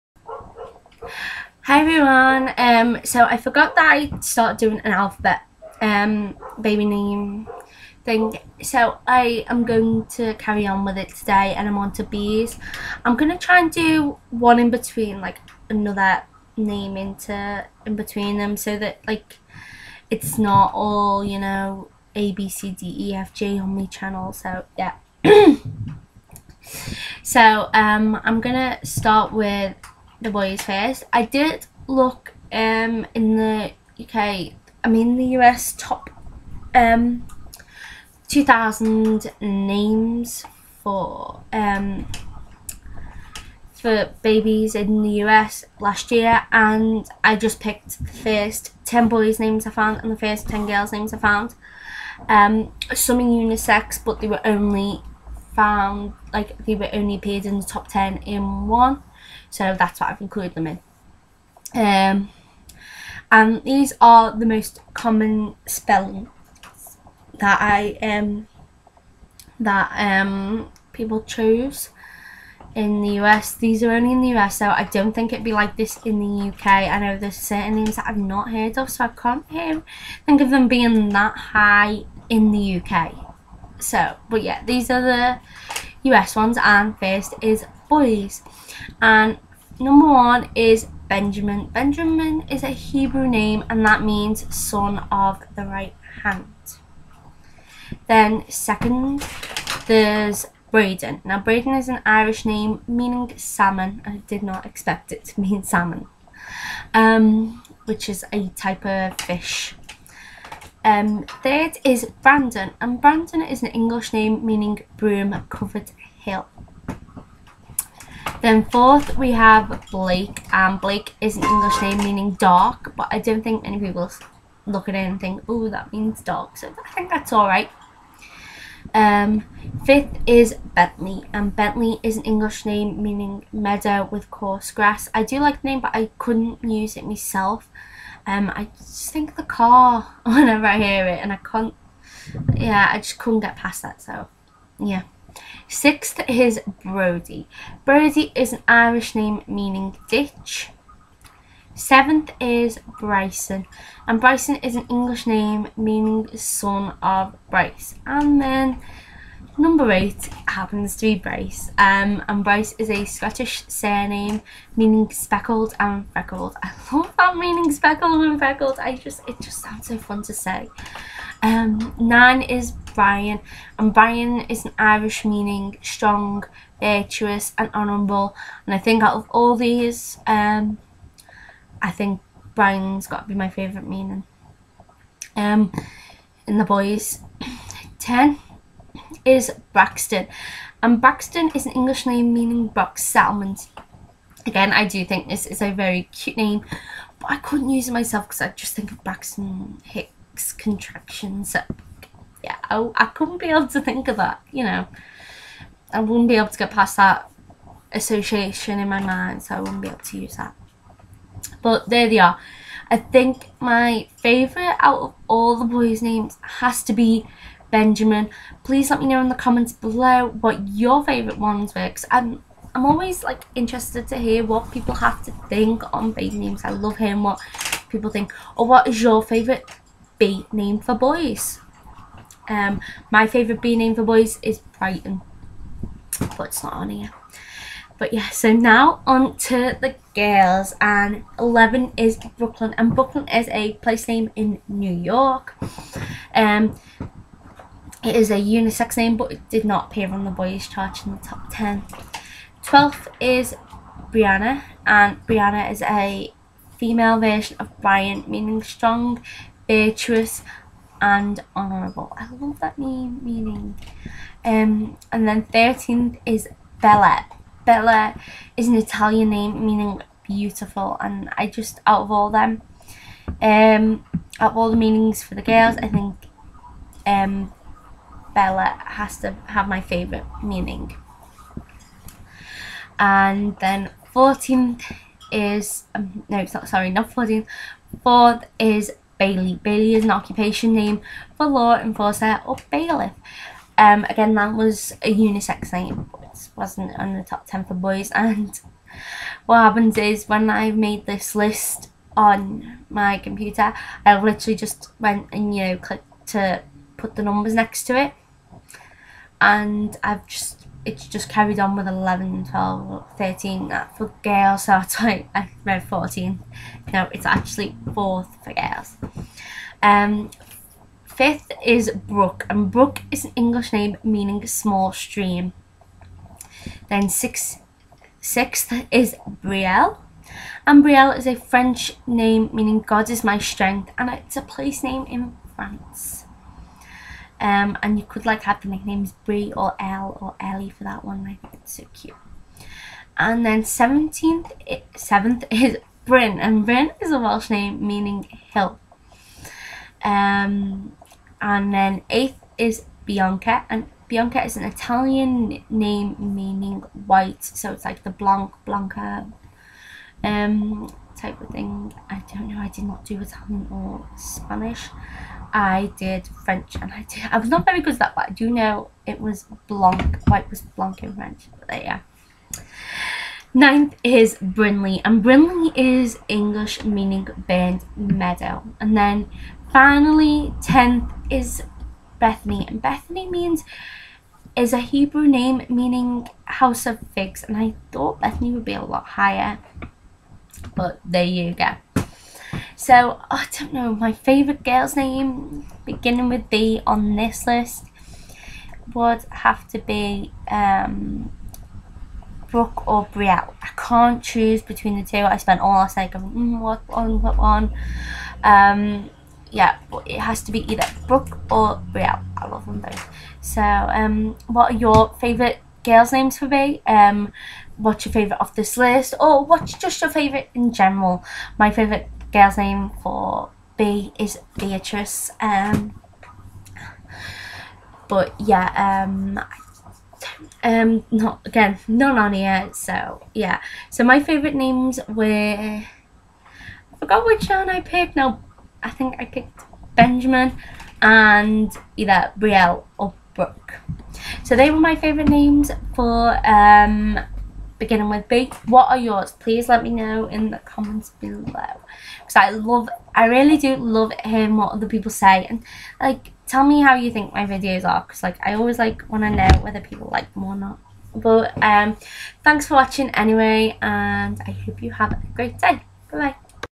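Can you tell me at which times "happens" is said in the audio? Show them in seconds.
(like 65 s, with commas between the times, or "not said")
160 s, 299 s.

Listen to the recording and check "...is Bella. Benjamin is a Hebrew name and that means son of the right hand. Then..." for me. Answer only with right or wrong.
wrong.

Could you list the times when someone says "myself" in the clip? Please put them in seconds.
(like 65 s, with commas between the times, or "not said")
137 s, 197 s.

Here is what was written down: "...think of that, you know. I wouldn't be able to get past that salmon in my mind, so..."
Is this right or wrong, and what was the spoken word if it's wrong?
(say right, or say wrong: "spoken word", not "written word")
wrong: "association", not "salmon".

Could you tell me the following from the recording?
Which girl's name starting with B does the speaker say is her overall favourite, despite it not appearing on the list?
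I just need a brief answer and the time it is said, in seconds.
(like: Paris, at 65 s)
Beatrice, at 424 s.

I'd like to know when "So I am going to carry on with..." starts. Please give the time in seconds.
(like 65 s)
8 s.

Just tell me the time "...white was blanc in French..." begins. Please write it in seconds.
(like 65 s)
370 s.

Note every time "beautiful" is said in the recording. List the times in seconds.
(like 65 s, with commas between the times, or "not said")
270 s.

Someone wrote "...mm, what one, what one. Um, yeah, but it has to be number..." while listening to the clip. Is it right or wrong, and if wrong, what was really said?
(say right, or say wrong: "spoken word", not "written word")
wrong: "either", not "number".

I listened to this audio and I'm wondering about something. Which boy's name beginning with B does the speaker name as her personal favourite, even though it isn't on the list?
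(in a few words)
Brighton.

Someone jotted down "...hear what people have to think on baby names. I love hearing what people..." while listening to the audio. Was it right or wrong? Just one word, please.
right.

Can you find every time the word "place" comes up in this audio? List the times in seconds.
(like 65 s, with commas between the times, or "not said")
243 s, 334 s.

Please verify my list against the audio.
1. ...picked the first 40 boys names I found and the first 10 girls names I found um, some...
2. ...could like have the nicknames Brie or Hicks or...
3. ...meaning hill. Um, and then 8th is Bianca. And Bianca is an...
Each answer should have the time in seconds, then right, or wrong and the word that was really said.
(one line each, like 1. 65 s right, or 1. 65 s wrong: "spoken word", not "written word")
1. 47 s wrong: "10", not "40"
2. 338 s wrong: "Elle", not "Hicks"
3. 347 s right.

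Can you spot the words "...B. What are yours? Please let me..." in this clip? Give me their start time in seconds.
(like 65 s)
448 s.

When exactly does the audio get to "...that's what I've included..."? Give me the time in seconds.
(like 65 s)
59 s.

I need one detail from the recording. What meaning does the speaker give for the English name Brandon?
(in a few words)
Broom covered hill.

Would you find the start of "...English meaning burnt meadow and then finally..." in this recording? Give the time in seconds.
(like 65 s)
376 s.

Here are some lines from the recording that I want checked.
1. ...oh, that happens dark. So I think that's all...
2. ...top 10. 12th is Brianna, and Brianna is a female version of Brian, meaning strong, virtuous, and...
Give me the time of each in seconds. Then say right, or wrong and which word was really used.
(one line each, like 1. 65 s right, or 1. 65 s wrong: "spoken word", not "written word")
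1. 125 s wrong: "means", not "happens"
2. 251 s right.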